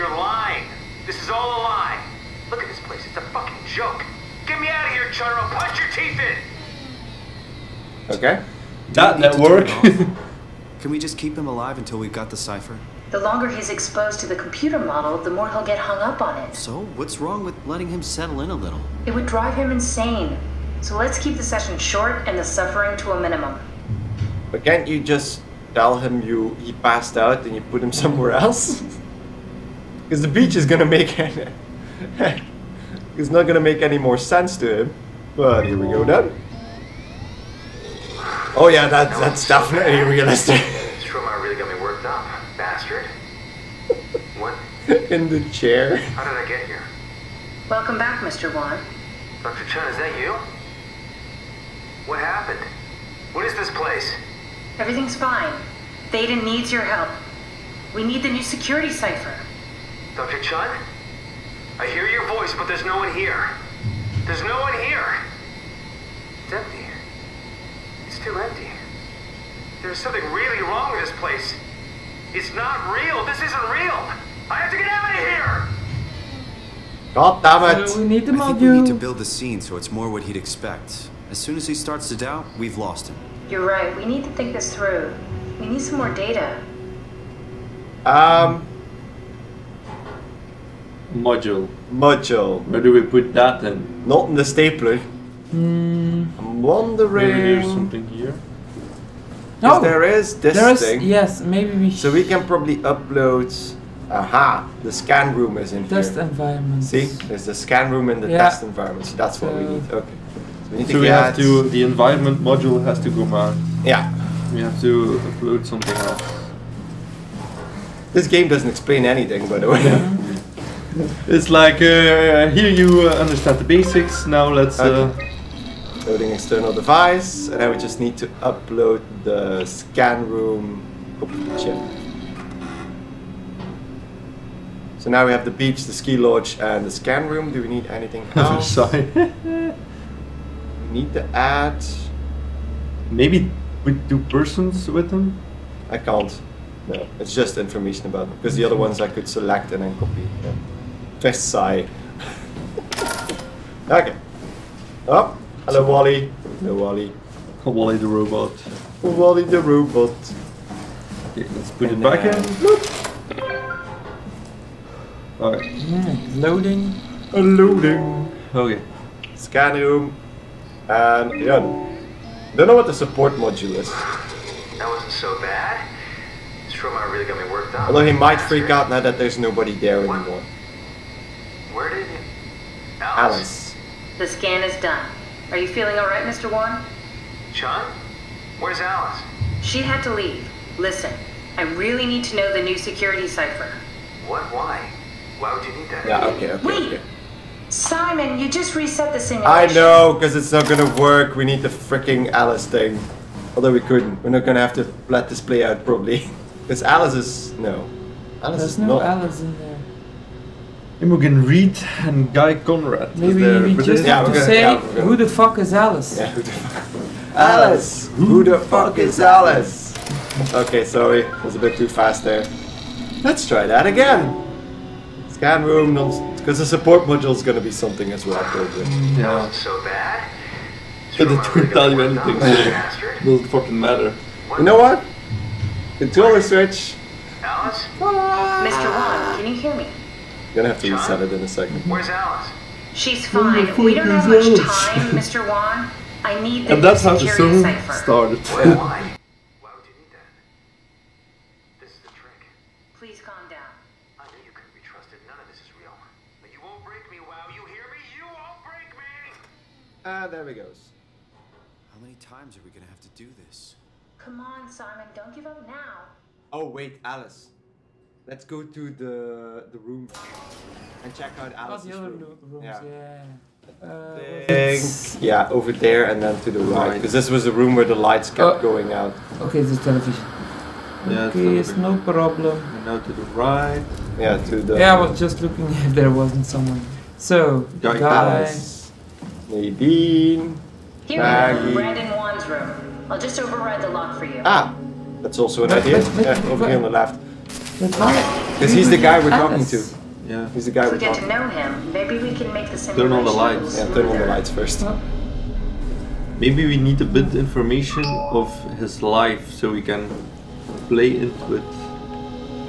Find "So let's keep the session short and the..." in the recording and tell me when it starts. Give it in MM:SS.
00:20.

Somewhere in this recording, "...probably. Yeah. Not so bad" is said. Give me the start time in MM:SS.
03:48.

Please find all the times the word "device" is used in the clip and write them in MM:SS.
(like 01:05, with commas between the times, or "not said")
02:06.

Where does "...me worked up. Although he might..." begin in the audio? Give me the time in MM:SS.
02:57.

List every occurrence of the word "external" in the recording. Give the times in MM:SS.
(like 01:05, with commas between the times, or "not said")
02:06.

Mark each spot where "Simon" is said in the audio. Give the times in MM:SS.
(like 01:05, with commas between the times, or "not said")
03:17, 04:24.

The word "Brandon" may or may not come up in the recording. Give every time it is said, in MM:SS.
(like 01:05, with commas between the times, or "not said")
04:51.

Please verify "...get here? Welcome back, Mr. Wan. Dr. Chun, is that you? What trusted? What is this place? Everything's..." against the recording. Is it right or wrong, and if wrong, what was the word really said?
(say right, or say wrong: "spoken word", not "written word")
wrong: "happened", not "trusted".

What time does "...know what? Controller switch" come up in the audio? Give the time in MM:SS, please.
03:54.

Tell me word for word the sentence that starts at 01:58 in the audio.
This game doesn't explain anything, by the way.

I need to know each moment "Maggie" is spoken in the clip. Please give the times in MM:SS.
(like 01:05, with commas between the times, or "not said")
04:51.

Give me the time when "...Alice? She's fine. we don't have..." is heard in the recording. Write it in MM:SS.
04:02.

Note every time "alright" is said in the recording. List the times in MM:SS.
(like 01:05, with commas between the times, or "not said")
02:45, 03:05.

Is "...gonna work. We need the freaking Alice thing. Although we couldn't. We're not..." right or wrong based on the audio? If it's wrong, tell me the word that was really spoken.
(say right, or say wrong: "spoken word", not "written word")
right.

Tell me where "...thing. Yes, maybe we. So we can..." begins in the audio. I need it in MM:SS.
01:40.